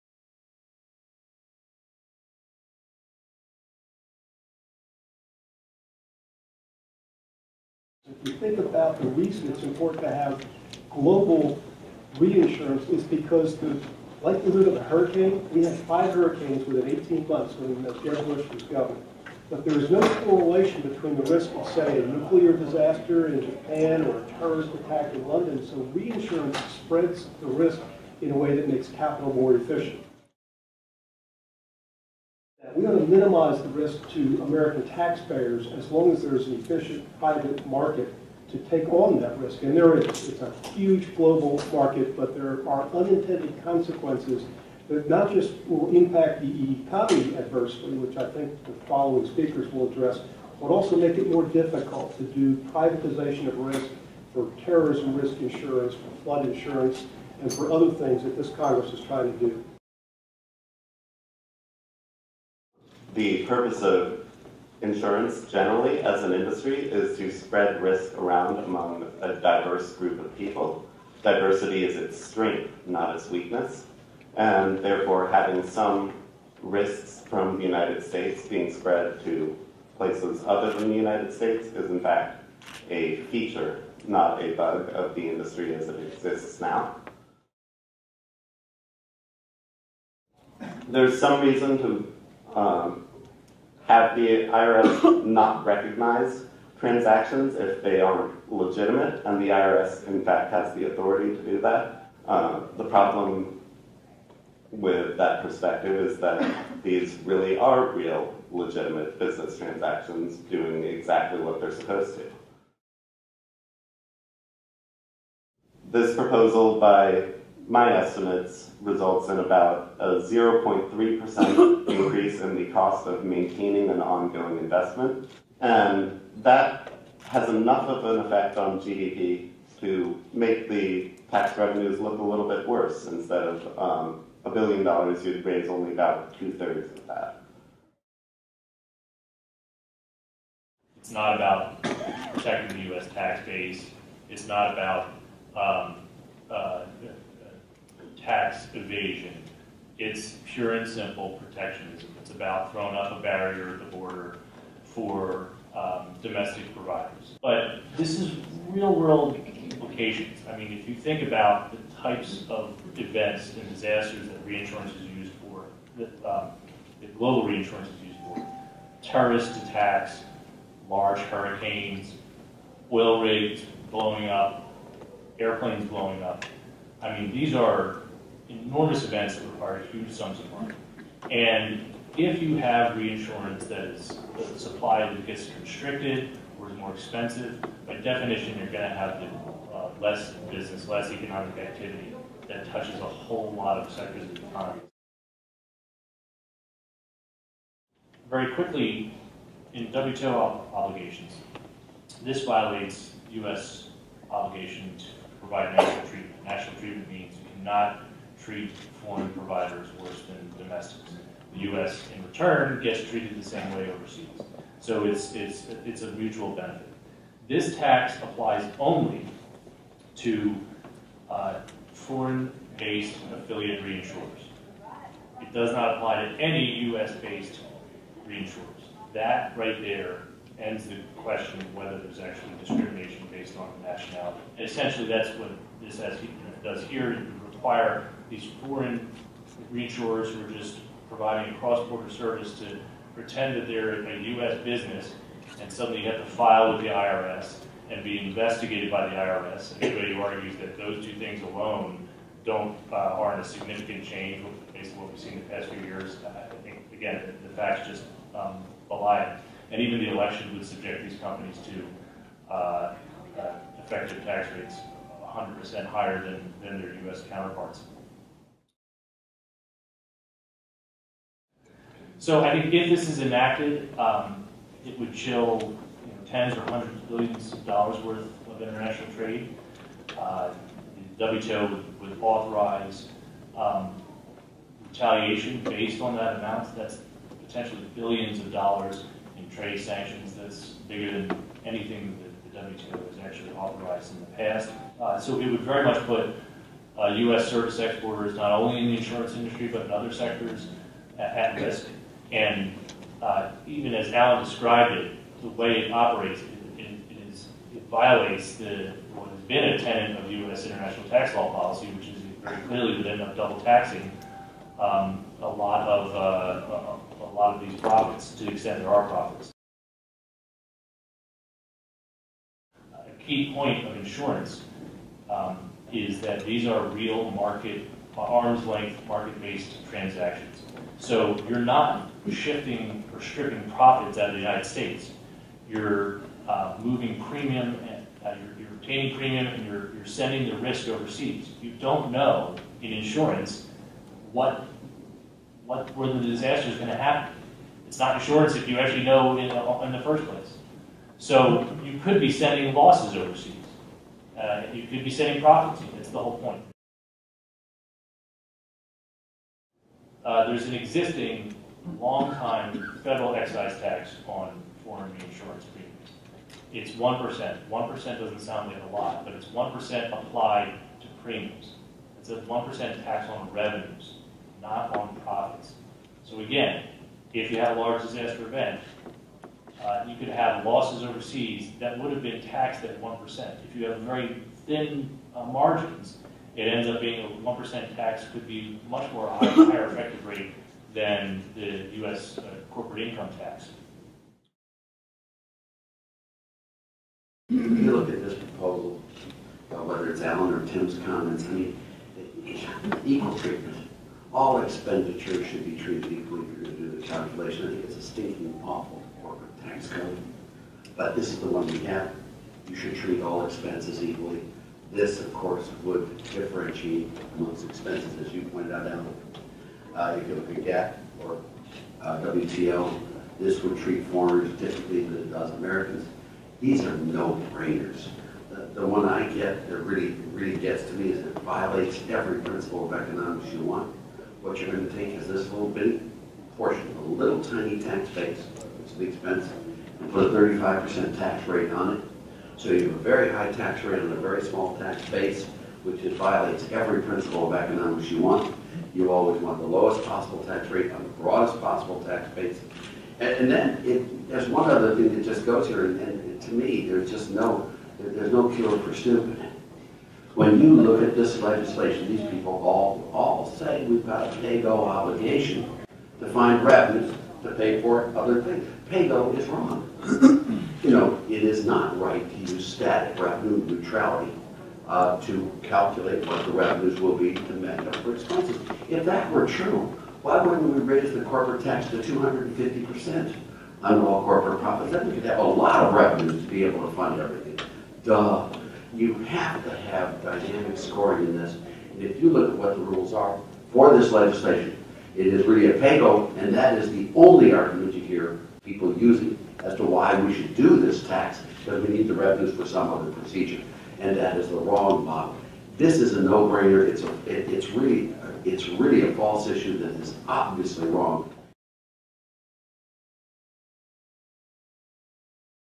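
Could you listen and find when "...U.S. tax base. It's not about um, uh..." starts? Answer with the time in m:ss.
2:22.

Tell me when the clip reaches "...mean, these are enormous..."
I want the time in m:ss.
2:57.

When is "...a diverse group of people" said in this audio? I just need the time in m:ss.
1:09.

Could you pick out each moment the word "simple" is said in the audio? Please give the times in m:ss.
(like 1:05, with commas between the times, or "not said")
2:30.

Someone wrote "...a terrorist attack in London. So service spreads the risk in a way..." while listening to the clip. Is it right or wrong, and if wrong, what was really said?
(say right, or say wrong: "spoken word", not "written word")
wrong: "reinsurance", not "service".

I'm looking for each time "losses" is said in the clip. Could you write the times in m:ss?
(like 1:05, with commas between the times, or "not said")
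5:52, 6:20.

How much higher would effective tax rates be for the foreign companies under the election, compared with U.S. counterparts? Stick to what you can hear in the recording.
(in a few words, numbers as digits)
100%.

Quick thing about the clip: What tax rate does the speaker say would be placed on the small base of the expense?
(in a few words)
35%.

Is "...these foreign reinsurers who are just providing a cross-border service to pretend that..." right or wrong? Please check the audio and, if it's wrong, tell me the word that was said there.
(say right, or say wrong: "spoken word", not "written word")
right.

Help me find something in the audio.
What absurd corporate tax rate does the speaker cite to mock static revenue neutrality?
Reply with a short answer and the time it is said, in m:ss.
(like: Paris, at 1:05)
250%, at 8:01.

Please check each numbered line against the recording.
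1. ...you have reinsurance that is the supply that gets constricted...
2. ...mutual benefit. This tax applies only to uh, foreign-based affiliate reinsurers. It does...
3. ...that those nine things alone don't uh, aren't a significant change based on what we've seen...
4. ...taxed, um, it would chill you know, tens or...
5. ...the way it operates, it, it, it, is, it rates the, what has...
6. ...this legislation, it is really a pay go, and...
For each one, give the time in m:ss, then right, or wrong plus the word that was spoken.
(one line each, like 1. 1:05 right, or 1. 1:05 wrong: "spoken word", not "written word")
1. 3:02 right
2. 3:36 right
3. 4:10 wrong: "two", not "nine"
4. 4:33 wrong: "enacted", not "taxed"
5. 5:05 wrong: "violates", not "rates"
6. 8:13 right.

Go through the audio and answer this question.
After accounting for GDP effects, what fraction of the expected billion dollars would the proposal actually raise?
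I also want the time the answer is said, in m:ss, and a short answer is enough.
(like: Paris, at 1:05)
two thirds, at 2:16.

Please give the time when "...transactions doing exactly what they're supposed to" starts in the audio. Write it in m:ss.
1:49.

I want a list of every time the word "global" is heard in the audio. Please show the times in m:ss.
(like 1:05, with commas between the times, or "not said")
0:10, 0:41, 2:47.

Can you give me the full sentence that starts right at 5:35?
You're uh, moving premium, and, uh, you're, you're, obtaining premium, and you're, you're sending the risk overseas.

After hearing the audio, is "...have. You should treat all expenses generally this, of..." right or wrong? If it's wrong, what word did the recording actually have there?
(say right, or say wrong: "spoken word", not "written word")
wrong: "equally", not "generally".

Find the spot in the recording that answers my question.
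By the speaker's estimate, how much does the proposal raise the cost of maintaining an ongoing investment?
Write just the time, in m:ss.
2:00.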